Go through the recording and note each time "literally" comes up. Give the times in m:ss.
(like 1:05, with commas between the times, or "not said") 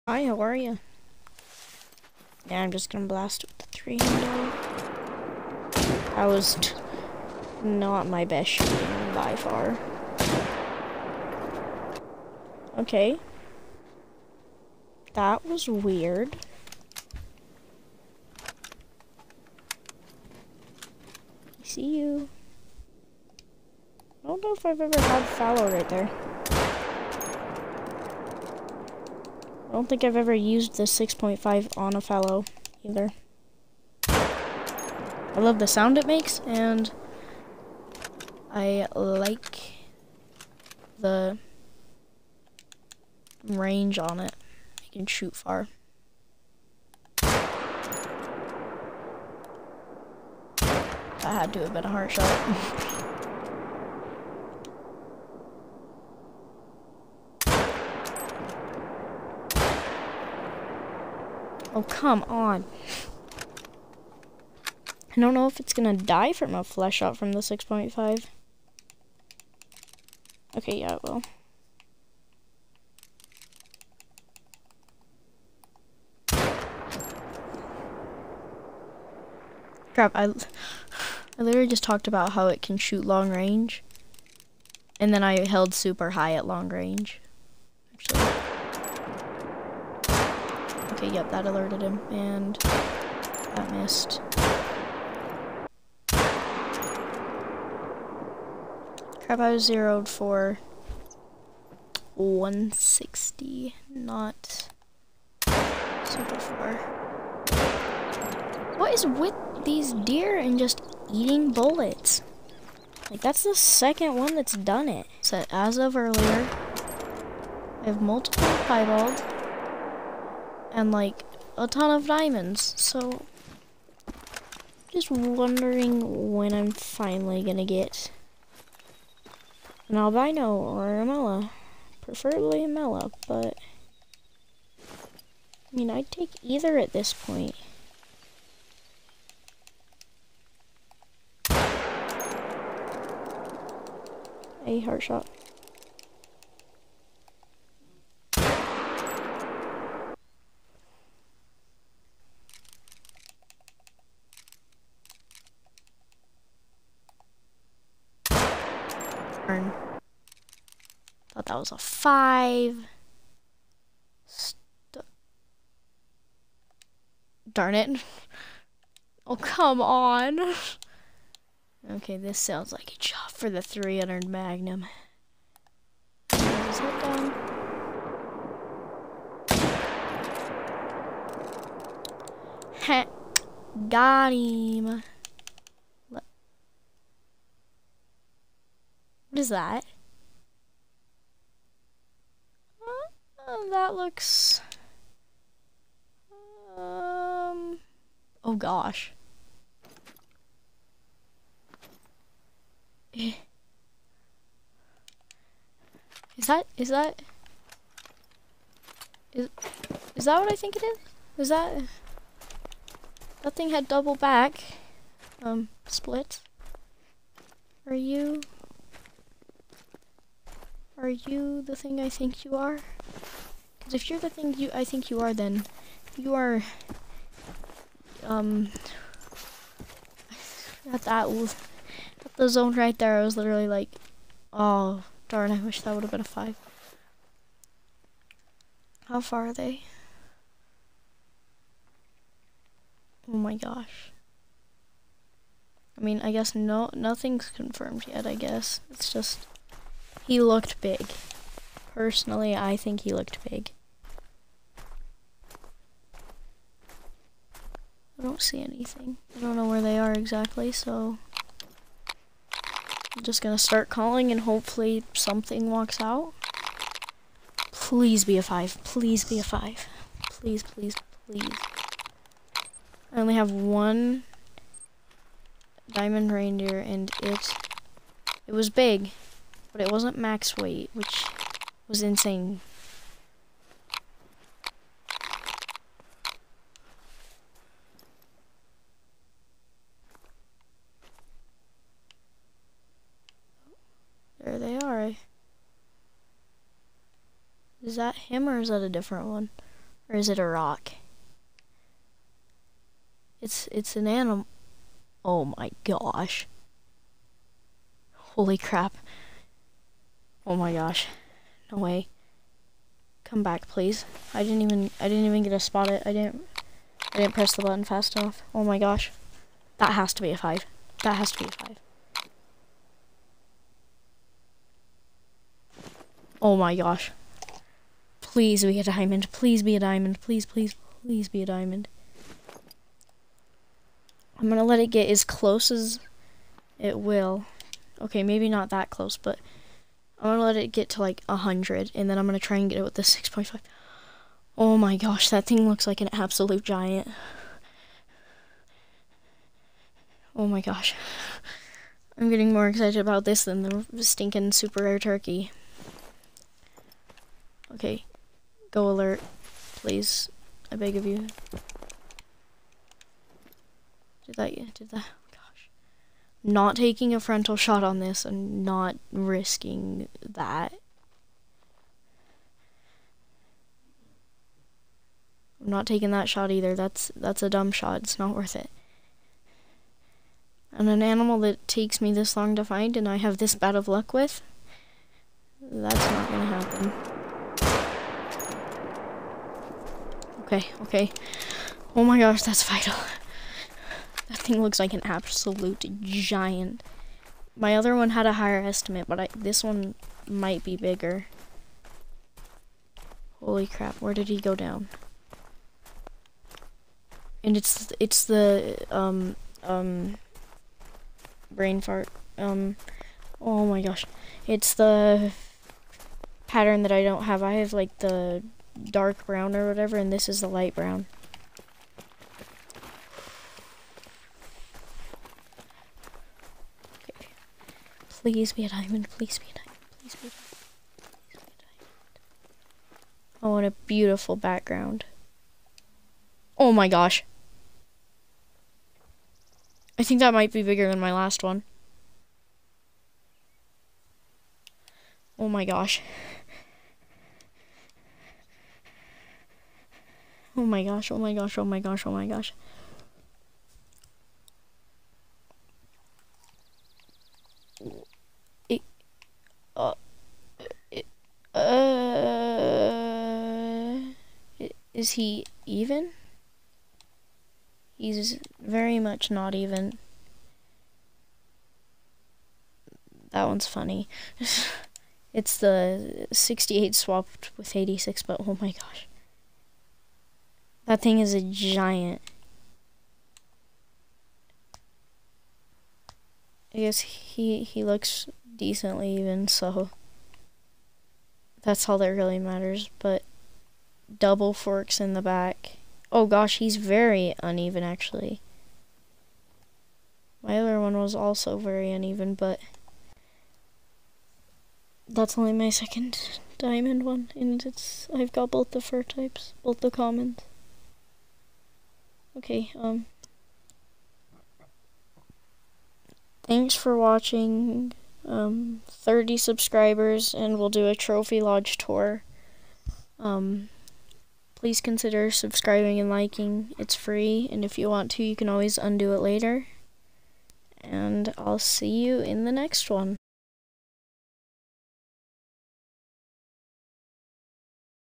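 1:21, 3:53.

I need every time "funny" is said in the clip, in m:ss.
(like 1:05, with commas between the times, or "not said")
7:53.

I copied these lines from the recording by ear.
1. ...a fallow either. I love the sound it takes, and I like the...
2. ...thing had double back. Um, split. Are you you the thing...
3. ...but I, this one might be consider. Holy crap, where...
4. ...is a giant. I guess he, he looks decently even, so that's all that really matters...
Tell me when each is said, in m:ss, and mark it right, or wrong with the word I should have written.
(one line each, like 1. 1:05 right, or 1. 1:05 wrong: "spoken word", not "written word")
1. 0:31 wrong: "makes", not "takes"
2. 3:33 right
3. 6:39 wrong: "bigger", not "consider"
4. 8:01 right.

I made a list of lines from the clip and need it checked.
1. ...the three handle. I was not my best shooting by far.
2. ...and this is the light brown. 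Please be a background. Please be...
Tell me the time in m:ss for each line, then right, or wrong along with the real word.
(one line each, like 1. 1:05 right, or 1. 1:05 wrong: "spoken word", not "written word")
1. 0:03 right
2. 6:59 wrong: "diamond", not "background".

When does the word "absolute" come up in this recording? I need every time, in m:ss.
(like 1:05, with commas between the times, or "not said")
5:46, 6:35.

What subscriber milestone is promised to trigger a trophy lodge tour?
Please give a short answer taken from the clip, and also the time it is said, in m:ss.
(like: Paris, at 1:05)
30, at 8:38.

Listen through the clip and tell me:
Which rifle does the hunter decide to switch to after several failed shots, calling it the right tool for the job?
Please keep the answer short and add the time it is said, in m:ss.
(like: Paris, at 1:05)
300 Magnum, at 2:53.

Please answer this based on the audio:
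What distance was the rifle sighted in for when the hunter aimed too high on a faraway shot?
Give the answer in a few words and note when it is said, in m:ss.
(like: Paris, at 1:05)
160, at 1:42.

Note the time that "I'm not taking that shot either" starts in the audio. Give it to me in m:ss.
6:15.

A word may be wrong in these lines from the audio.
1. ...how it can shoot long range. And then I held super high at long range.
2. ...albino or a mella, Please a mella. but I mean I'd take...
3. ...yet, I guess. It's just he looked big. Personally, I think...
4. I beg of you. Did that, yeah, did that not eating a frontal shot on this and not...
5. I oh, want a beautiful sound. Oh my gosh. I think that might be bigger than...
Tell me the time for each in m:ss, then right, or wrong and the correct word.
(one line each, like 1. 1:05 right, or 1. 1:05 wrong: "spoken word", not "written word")
1. 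1:22 right
2. 2:09 wrong: "Preferably", not "Please"
3. 4:08 right
4. 6:00 wrong: "taking", not "eating"
5. 7:13 wrong: "background", not "sound".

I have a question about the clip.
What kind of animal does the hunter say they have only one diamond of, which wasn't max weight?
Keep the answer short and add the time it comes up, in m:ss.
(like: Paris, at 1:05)
reindeer, at 4:36.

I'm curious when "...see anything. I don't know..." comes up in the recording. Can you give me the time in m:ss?
4:18.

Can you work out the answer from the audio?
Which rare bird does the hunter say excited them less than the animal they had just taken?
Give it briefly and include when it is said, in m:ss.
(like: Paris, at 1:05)
turkey, at 5:54.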